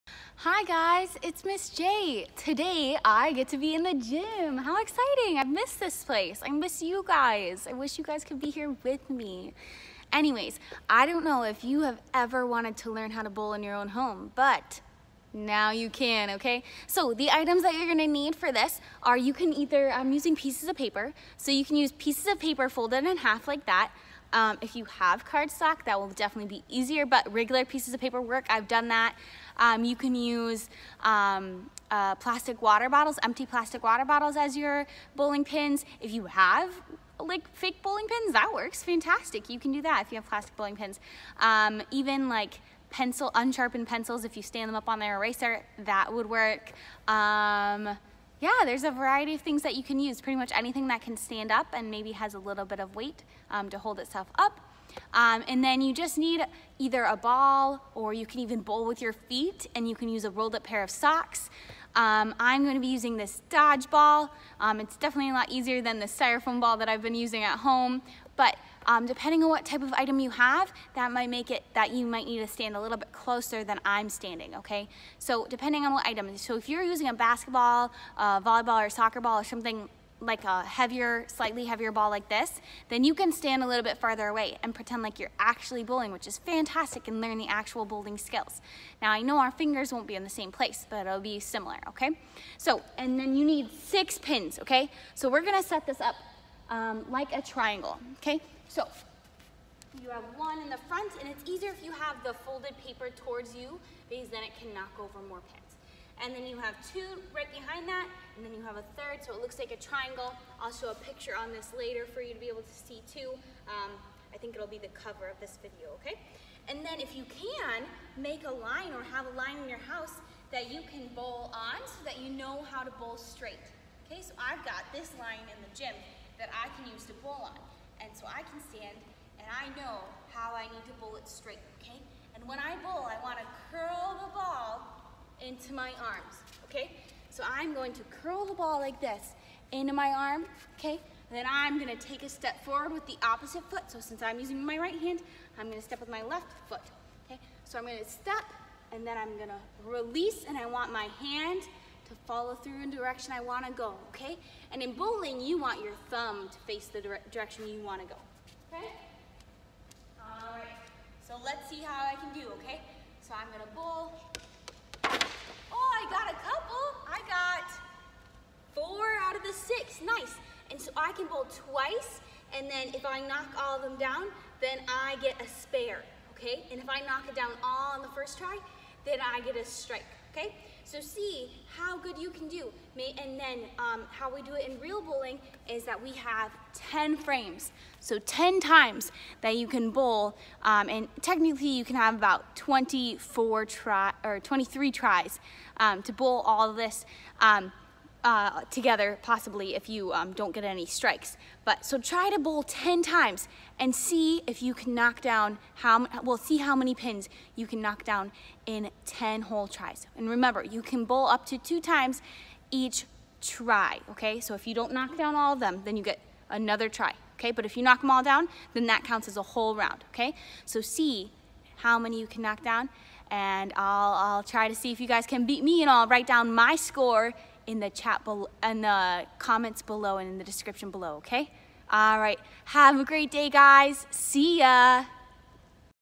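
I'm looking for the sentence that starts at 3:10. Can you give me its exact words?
Um, and technically you can have about 24 try or 23 tries um, to bowl all of this.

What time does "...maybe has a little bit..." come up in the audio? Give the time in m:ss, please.
0:51.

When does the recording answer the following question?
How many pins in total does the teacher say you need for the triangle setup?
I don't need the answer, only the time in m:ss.
1:33.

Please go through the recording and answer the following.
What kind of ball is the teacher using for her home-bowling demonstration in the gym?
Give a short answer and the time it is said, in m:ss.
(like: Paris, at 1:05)
Dodgeball, at 1:03.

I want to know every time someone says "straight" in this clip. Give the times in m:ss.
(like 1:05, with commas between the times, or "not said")
2:03, 2:11.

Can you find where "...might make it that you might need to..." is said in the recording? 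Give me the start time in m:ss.
1:11.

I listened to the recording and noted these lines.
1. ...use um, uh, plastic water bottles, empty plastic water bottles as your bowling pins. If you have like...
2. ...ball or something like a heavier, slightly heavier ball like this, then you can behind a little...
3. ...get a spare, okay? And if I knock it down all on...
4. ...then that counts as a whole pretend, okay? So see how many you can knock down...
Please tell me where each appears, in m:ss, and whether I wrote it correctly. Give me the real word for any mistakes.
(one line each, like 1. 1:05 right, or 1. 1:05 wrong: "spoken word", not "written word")
1. 0:30 right
2. 1:19 wrong: "stand", not "behind"
3. 2:55 right
4. 3:38 wrong: "round", not "pretend".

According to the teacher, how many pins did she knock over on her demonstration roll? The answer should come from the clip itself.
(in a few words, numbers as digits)
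4.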